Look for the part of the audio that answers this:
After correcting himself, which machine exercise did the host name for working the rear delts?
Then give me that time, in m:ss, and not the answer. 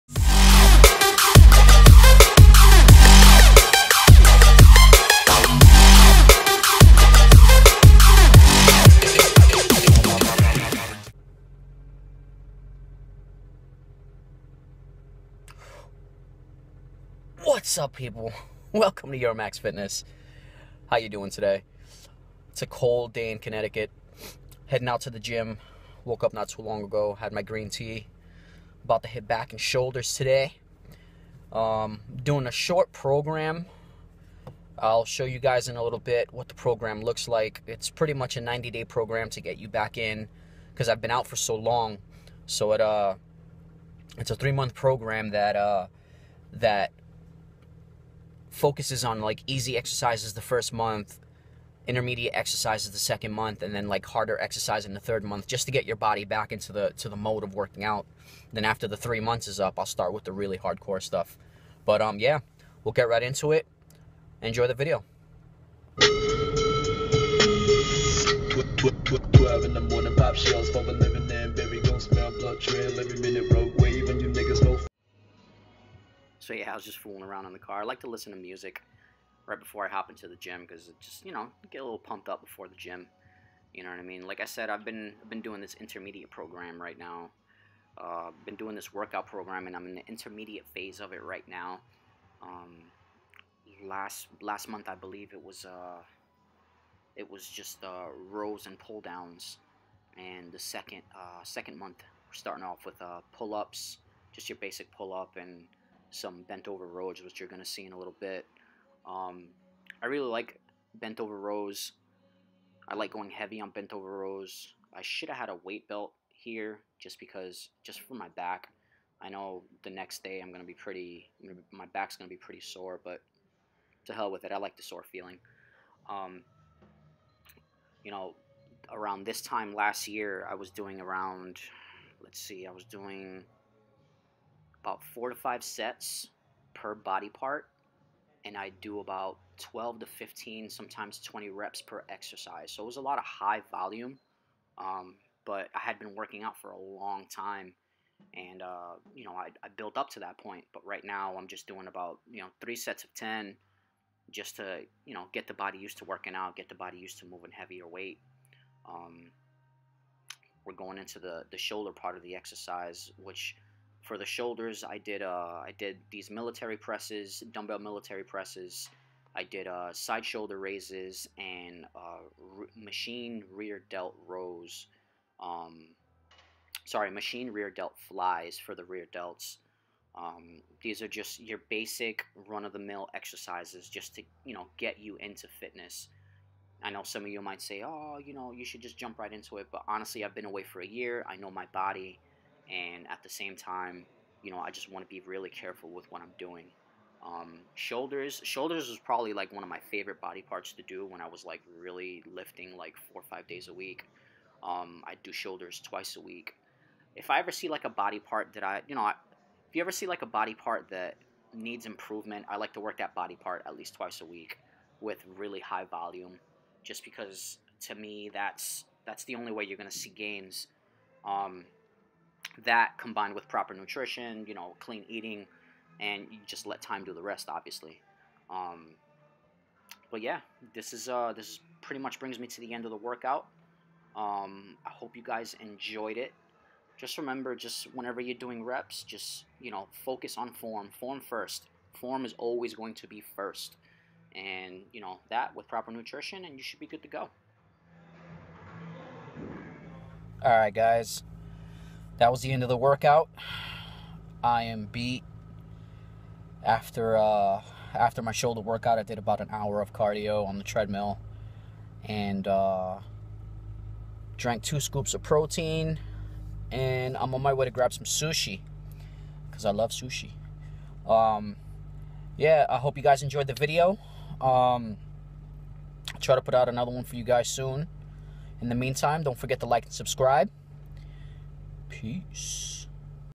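2:57.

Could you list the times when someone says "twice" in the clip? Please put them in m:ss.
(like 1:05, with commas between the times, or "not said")
3:25, 3:33.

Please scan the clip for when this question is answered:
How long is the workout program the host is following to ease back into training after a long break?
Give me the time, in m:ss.
0:38.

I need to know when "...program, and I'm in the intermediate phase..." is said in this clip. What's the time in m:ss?
1:29.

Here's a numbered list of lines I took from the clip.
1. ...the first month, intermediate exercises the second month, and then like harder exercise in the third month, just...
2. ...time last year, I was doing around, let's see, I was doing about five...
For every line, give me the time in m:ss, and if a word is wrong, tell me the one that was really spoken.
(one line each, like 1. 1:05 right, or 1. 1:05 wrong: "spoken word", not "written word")
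1. 0:50 right
2. 2:09 wrong: "four", not "five".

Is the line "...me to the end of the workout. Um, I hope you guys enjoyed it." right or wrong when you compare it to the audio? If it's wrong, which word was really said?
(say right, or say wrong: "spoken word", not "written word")
right.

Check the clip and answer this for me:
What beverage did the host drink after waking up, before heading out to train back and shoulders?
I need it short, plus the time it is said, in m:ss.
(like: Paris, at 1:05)
green tea, at 0:27.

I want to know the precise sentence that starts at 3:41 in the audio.
Um, that combined with proper nutrition, you know, clean eating, and you just let time do the rest, obviously.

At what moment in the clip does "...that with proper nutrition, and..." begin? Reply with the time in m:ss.
4:05.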